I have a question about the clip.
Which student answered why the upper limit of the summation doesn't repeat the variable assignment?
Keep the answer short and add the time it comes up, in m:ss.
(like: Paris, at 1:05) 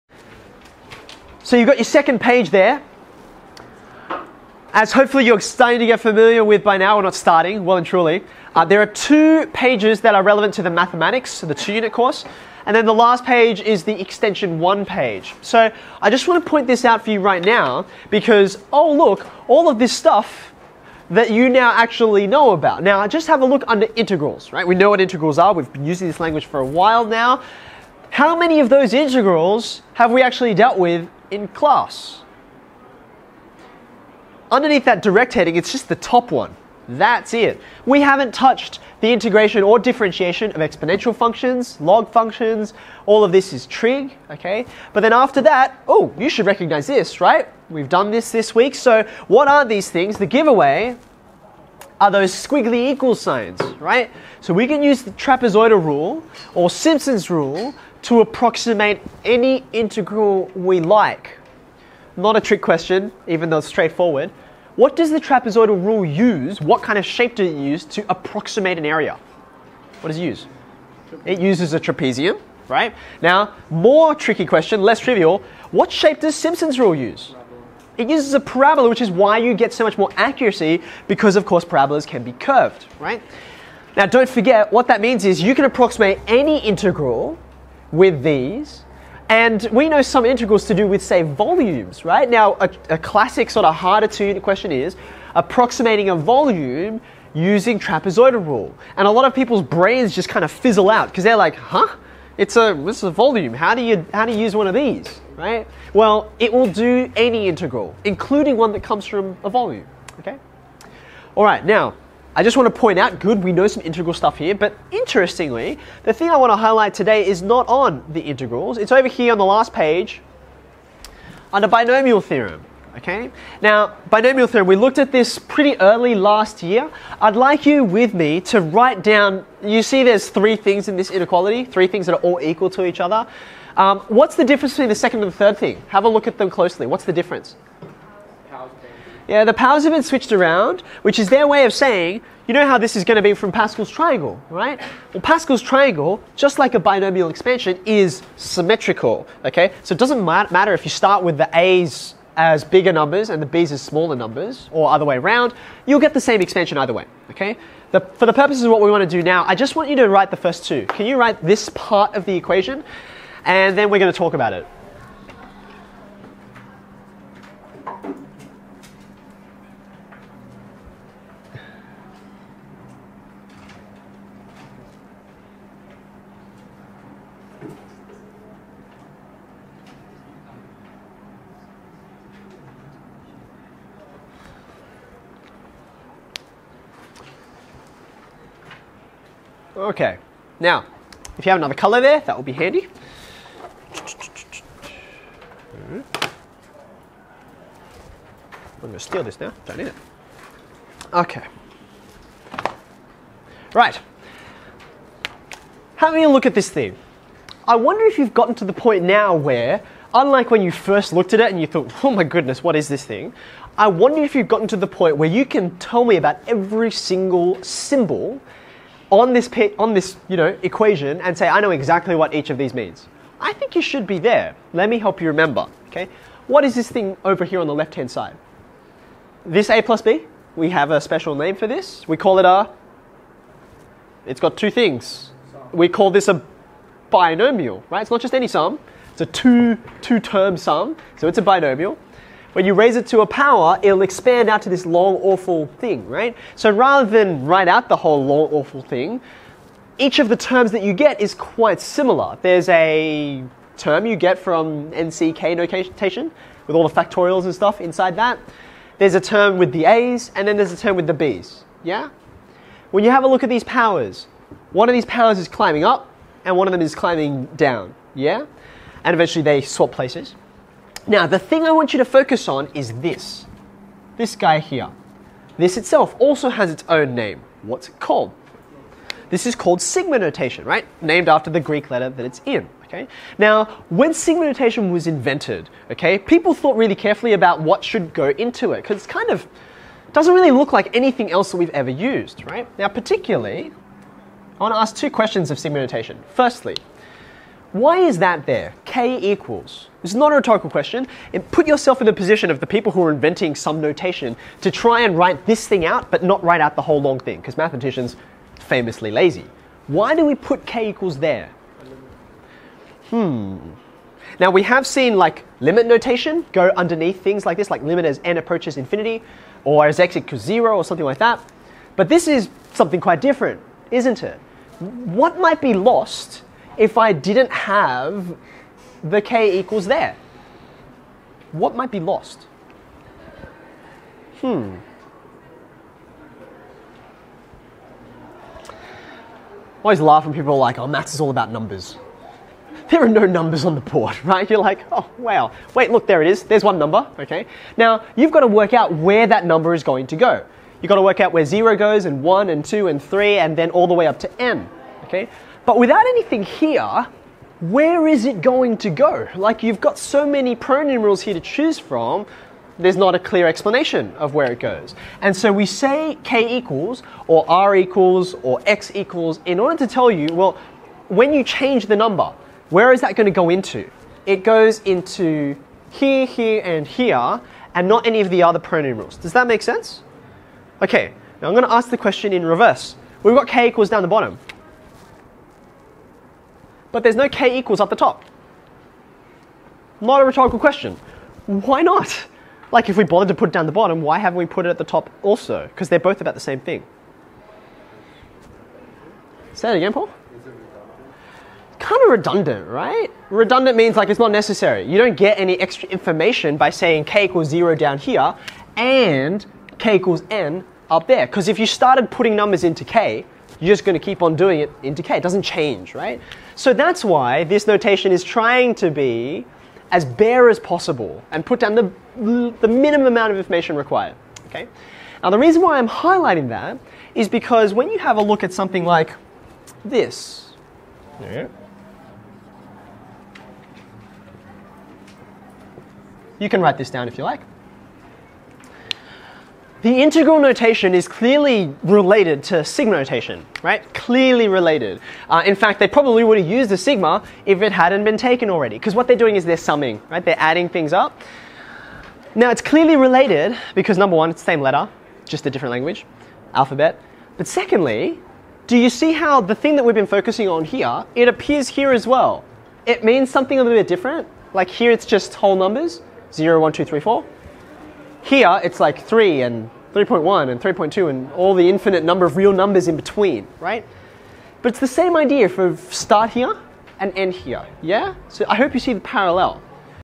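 Paul, at 6:39.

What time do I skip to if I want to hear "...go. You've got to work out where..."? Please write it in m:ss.
5:50.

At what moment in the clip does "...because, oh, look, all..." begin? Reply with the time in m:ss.
0:18.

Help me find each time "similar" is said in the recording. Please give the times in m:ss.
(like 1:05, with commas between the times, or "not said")
4:11.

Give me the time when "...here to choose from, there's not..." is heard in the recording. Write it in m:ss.
6:01.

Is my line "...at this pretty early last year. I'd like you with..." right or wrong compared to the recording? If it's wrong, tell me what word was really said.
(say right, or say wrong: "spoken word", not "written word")
right.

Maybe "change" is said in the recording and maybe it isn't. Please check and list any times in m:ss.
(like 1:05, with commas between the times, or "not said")
6:11, 6:55.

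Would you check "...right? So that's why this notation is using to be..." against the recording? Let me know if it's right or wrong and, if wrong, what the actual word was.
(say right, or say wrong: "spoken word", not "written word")
wrong: "trying", not "using".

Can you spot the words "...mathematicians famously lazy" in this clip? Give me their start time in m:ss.
5:07.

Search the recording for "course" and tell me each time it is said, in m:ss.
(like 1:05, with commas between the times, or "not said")
0:11, 1:21.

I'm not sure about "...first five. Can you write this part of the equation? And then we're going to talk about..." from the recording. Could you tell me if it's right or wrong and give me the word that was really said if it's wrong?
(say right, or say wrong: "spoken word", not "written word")
wrong: "two", not "five".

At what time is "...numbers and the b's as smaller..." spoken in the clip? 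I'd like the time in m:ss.
2:32.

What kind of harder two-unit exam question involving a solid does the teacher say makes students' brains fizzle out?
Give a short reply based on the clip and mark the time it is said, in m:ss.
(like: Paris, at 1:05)
Approximating a volume, at 1:35.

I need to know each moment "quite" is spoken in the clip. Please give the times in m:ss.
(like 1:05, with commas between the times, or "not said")
4:11, 5:22.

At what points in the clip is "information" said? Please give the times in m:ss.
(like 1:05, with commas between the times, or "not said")
6:45, 7:03.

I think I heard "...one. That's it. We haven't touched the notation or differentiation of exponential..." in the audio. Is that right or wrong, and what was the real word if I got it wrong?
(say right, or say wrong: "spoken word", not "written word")
wrong: "integration", not "notation".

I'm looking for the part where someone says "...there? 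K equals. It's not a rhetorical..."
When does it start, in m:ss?
4:58.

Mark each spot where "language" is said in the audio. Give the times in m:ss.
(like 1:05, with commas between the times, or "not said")
0:26, 7:35.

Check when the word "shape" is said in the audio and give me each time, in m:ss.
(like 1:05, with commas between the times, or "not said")
1:07, 1:15.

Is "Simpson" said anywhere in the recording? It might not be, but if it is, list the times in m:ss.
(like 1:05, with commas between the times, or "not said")
0:56, 1:16.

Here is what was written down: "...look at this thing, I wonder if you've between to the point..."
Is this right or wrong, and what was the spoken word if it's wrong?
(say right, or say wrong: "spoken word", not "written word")
wrong: "gotten", not "between".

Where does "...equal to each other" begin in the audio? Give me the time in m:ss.
2:12.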